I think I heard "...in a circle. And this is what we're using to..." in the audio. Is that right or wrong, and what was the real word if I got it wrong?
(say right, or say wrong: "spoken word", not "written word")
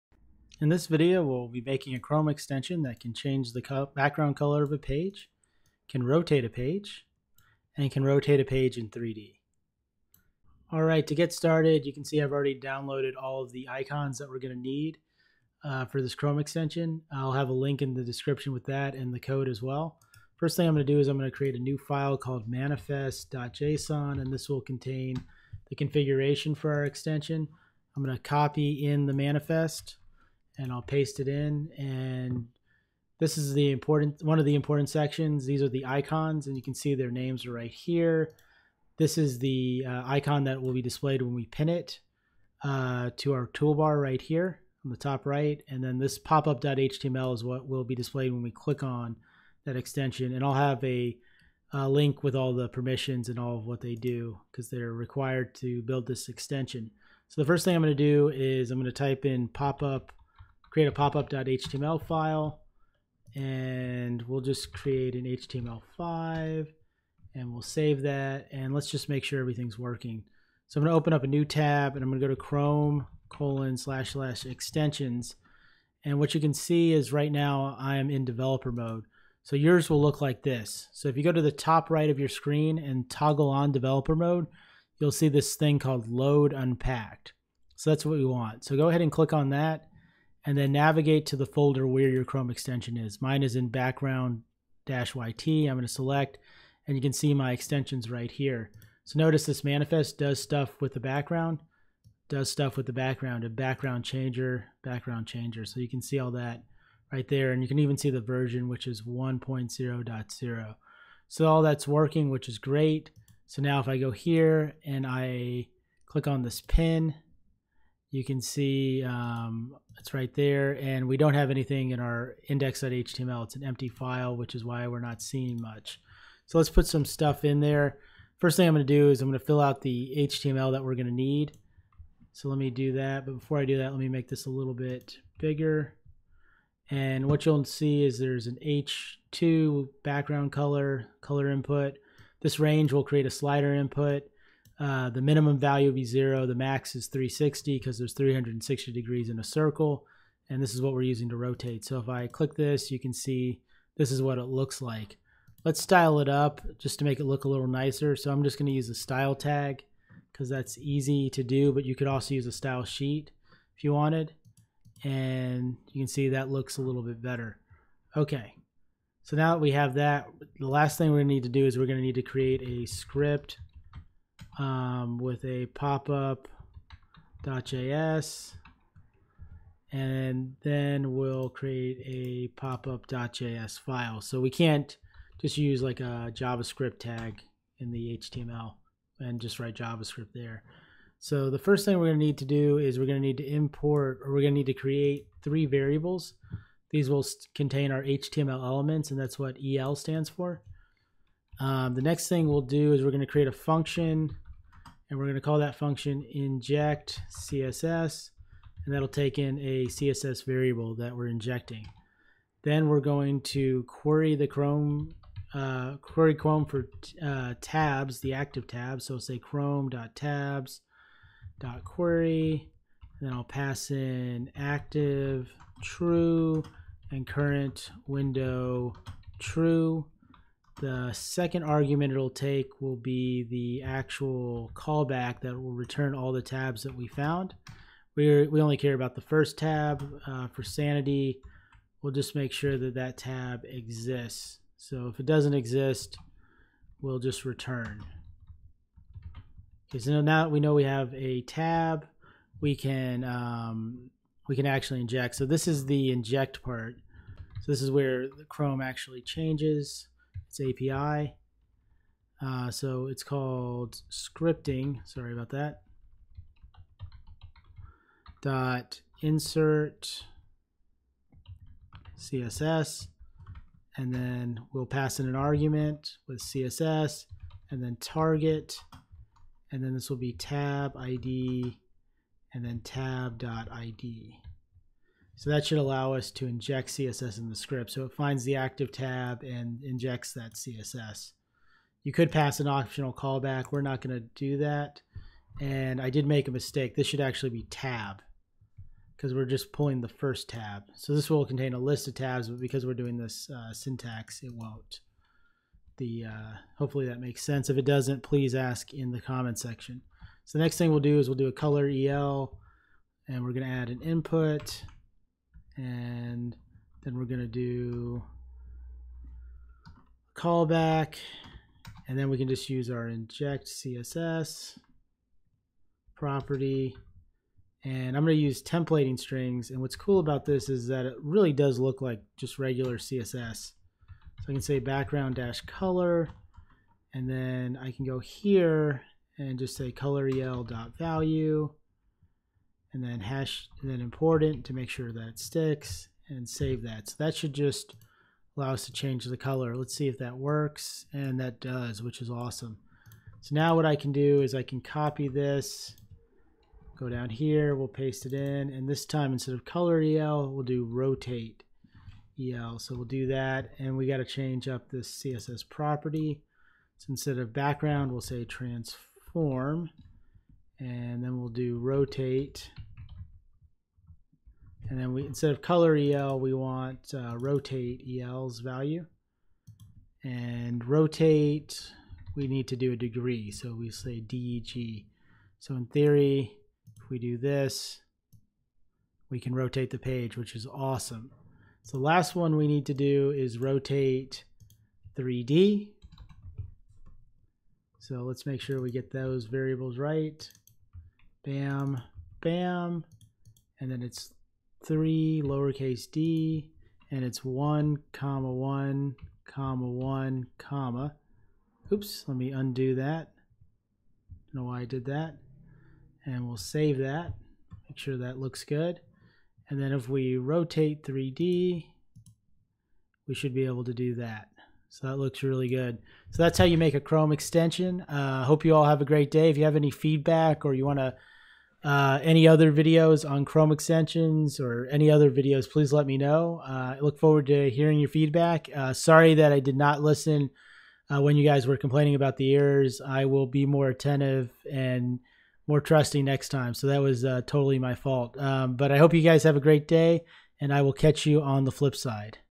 right.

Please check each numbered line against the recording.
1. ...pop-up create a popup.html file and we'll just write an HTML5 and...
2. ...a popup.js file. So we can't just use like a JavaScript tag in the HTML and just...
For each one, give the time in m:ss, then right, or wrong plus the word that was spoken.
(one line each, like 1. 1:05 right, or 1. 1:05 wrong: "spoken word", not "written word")
1. 0:59 wrong: "create", not "write"
2. 3:02 right.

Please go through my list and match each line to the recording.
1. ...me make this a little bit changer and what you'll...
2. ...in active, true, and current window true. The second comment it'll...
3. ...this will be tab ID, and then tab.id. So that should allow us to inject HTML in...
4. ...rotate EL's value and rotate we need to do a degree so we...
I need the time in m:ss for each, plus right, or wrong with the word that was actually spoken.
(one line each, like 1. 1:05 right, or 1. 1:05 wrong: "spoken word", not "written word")
1. 2:13 wrong: "bigger", not "changer"
2. 3:43 wrong: "argument", not "comment"
3. 4:39 wrong: "CSS", not "HTML"
4. 6:17 right.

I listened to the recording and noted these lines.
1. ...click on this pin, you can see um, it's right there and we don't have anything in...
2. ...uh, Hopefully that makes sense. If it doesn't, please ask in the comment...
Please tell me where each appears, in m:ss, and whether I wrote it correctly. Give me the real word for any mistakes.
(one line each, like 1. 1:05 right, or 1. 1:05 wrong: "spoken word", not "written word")
1. 1:56 right
2. 5:06 right.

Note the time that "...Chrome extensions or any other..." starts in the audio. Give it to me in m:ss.
7:13.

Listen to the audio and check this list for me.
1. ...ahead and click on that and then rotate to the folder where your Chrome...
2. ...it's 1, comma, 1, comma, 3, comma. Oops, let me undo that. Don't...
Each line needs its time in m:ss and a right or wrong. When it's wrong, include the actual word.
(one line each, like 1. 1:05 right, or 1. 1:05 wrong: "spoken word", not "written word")
1. 1:28 wrong: "navigate", not "rotate"
2. 6:47 wrong: "1", not "3".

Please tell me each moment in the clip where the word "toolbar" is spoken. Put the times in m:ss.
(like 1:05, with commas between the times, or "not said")
0:43.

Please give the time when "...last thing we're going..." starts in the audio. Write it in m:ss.
2:50.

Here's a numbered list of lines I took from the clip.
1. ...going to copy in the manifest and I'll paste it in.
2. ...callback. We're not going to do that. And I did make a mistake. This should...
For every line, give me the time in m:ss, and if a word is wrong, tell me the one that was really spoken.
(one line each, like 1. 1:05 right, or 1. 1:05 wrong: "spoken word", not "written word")
1. 0:28 right
2. 4:53 right.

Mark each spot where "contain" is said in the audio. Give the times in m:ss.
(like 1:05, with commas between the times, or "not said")
0:24, 3:17, 5:01.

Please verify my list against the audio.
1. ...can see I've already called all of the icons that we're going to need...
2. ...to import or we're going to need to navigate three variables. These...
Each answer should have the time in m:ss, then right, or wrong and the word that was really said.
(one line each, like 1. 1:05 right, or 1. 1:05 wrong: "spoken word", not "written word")
1. 0:11 wrong: "downloaded", not "called"
2. 3:13 wrong: "create", not "navigate".